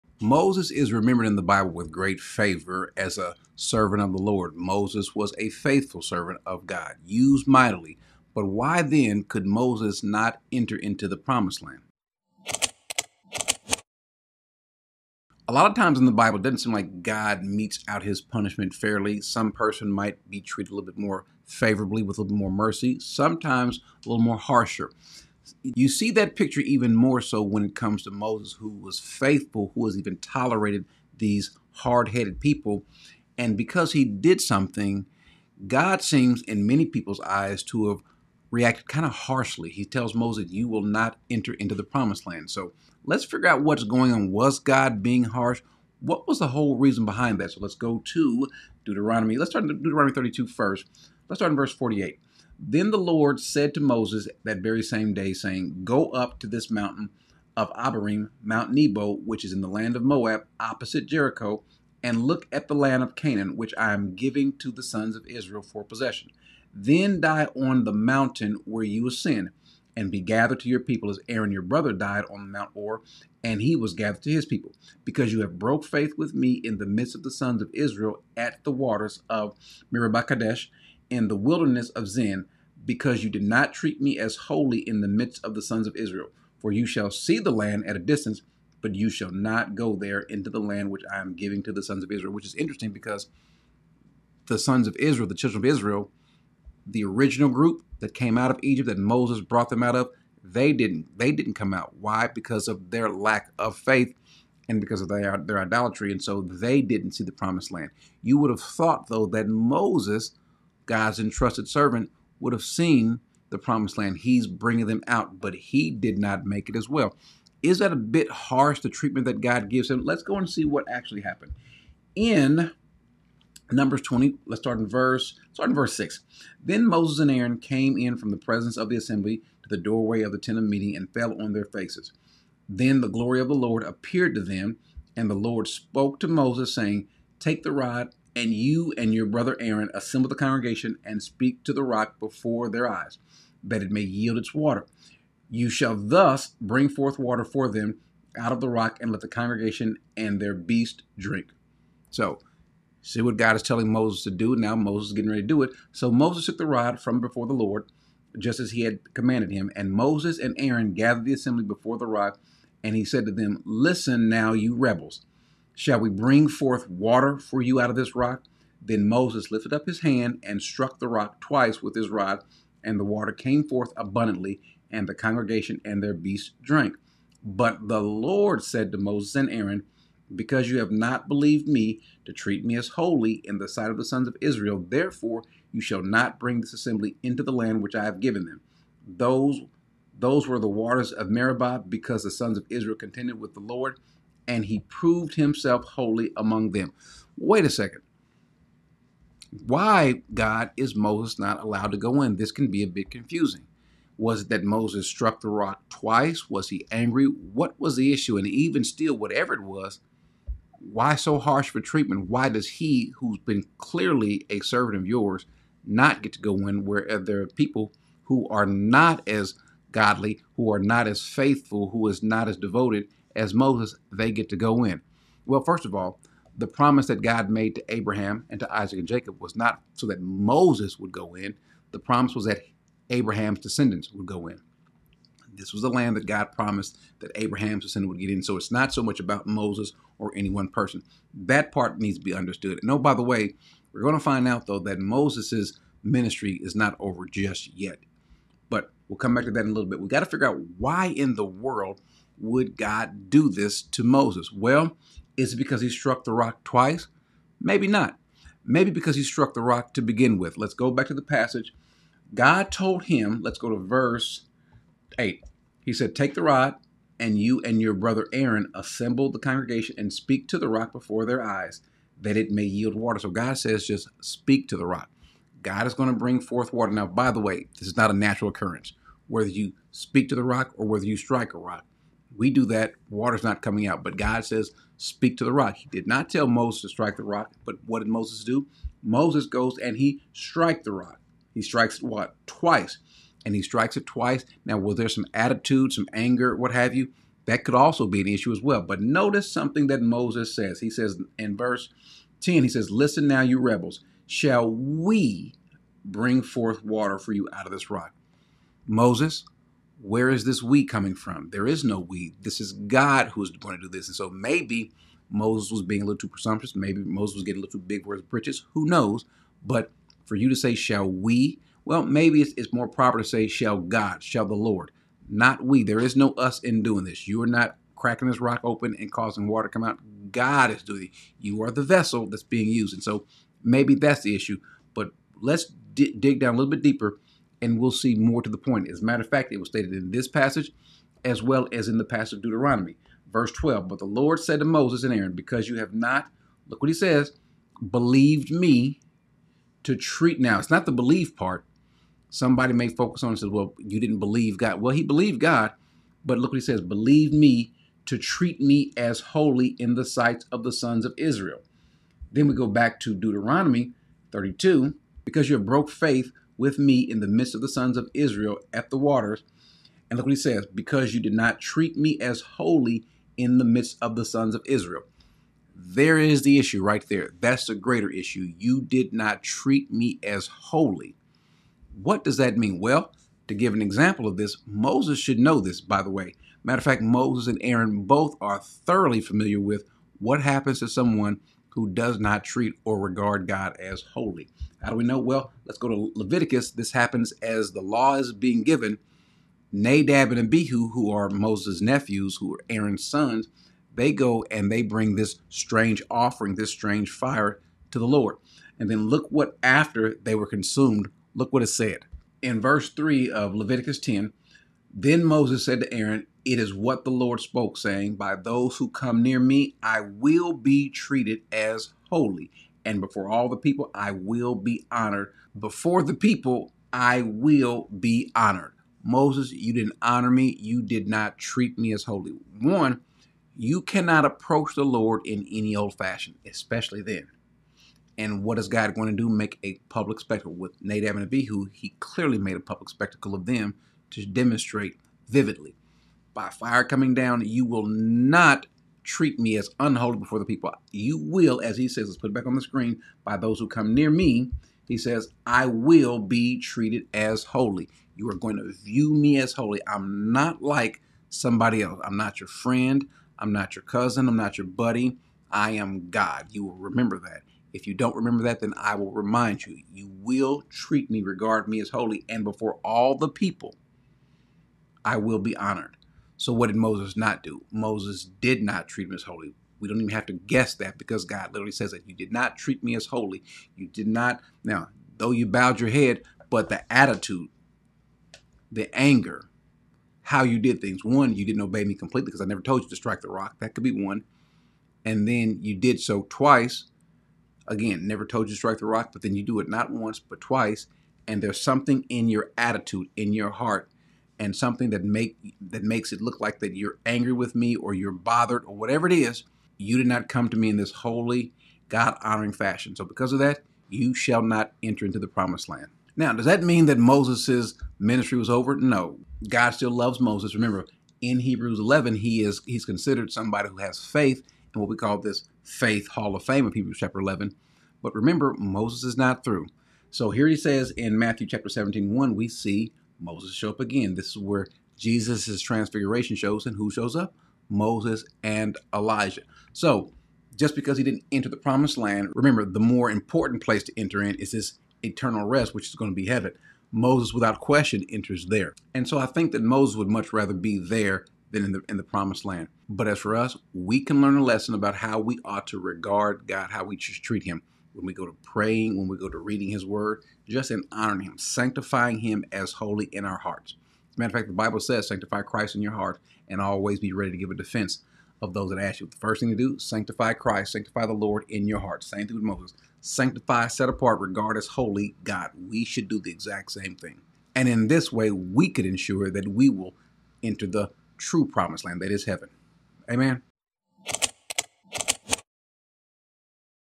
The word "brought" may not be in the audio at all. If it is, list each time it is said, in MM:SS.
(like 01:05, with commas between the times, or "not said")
01:39.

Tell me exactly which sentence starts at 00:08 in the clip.
But why then could Moses not enter into the promised land?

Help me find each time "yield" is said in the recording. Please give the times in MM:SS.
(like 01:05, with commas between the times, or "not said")
02:24, 04:32.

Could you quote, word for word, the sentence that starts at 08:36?
Now, does that mean that Moses' ministry was over?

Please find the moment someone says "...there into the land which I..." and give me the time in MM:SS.
01:29.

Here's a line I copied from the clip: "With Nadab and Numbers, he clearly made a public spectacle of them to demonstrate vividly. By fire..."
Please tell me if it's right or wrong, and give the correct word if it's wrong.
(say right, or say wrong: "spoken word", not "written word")
wrong: "Abihu", not "Numbers".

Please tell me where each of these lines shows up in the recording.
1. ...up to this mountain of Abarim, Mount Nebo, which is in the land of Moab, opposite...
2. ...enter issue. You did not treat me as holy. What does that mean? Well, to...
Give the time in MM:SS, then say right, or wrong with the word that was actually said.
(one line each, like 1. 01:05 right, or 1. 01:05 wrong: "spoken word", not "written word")
1. 00:56 right
2. 06:17 wrong: "greater", not "enter".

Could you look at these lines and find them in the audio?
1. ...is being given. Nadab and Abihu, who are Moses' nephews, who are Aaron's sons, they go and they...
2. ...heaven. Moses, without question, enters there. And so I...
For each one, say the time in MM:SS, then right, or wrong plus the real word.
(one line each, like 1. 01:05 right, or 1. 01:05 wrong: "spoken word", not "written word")
1. 06:38 right
2. 09:06 right.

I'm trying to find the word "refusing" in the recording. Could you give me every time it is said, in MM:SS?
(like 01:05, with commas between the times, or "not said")
not said.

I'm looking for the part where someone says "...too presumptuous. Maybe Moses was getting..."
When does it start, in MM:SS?
05:16.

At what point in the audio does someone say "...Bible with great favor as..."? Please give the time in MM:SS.
00:01.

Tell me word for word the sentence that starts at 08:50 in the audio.
So here he says in Matthew chapter 17, 1, we see Moses show up again.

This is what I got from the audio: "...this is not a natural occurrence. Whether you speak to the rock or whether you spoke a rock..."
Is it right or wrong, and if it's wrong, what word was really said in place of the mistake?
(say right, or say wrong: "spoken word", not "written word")
wrong: "strike", not "spoke".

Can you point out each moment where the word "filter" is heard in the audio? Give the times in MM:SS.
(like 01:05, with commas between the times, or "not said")
not said.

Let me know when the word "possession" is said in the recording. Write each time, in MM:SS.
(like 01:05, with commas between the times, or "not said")
01:05.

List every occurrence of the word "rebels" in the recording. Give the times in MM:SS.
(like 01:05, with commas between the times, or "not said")
02:44, 05:03.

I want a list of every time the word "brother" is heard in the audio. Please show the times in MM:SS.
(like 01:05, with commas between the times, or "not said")
01:11, 02:19, 04:27.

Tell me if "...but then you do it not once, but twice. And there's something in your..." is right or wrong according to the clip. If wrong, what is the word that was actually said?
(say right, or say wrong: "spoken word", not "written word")
right.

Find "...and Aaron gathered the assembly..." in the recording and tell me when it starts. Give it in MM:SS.
02:40.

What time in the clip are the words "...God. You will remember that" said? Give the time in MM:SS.
07:46.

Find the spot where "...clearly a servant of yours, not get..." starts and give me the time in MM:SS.
03:33.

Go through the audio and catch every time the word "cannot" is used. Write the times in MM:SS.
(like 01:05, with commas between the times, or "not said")
07:13.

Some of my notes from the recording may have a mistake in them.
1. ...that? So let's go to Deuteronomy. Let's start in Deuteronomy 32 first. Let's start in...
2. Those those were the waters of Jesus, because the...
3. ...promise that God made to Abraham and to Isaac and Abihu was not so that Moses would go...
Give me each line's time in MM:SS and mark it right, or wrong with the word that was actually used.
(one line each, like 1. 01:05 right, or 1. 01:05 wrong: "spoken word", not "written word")
1. 00:47 right
2. 03:09 wrong: "Meribah", not "Jesus"
3. 03:46 wrong: "Jacob", not "Abihu".